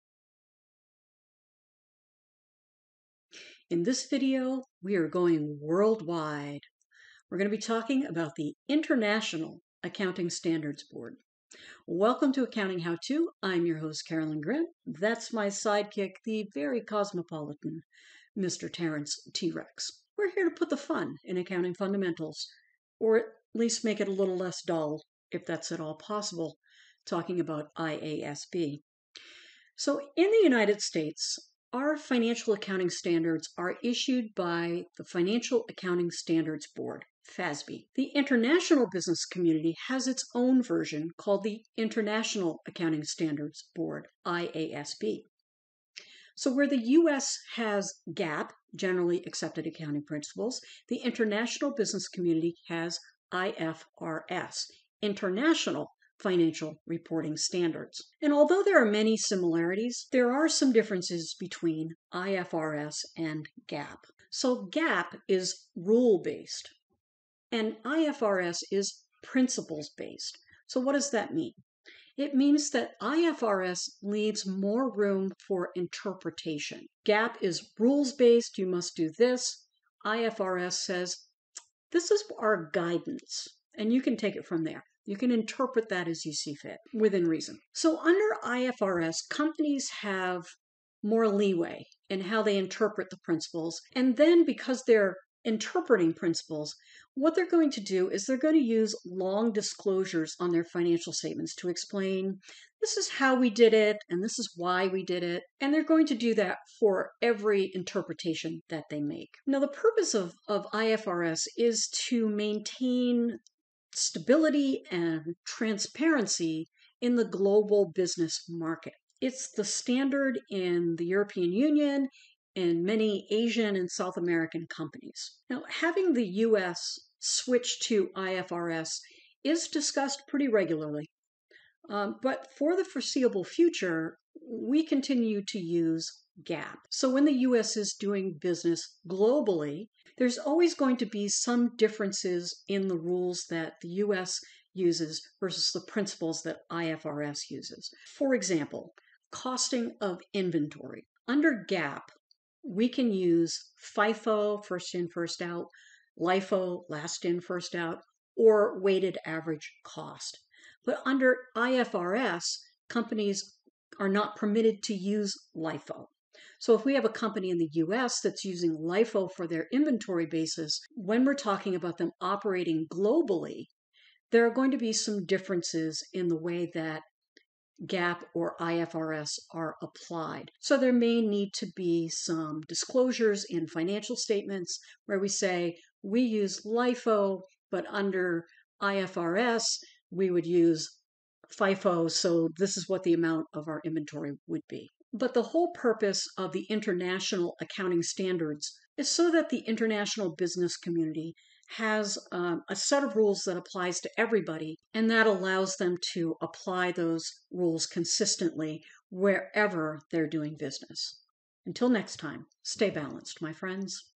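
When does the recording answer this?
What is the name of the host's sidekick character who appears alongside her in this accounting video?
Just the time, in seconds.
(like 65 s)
18 s.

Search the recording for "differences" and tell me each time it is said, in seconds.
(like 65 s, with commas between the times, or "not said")
60 s, 141 s, 175 s.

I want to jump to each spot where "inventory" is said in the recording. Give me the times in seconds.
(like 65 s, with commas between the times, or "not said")
150 s, 169 s, 193 s.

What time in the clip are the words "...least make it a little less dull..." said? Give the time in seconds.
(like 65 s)
23 s.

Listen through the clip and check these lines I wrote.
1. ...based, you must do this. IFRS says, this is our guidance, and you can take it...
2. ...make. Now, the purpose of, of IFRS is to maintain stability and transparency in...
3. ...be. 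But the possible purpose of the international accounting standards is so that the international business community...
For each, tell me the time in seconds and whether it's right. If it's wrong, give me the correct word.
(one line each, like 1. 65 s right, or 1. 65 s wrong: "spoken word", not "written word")
1. 78 s right
2. 109 s right
3. 194 s wrong: "whole", not "possible".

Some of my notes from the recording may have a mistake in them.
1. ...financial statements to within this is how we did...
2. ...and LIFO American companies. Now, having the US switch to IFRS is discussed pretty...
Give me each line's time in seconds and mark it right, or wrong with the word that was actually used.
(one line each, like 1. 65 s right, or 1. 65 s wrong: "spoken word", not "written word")
1. 100 s wrong: "explain", not "within"
2. 123 s wrong: "South", not "LIFO".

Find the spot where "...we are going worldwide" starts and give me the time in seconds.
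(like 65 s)
4 s.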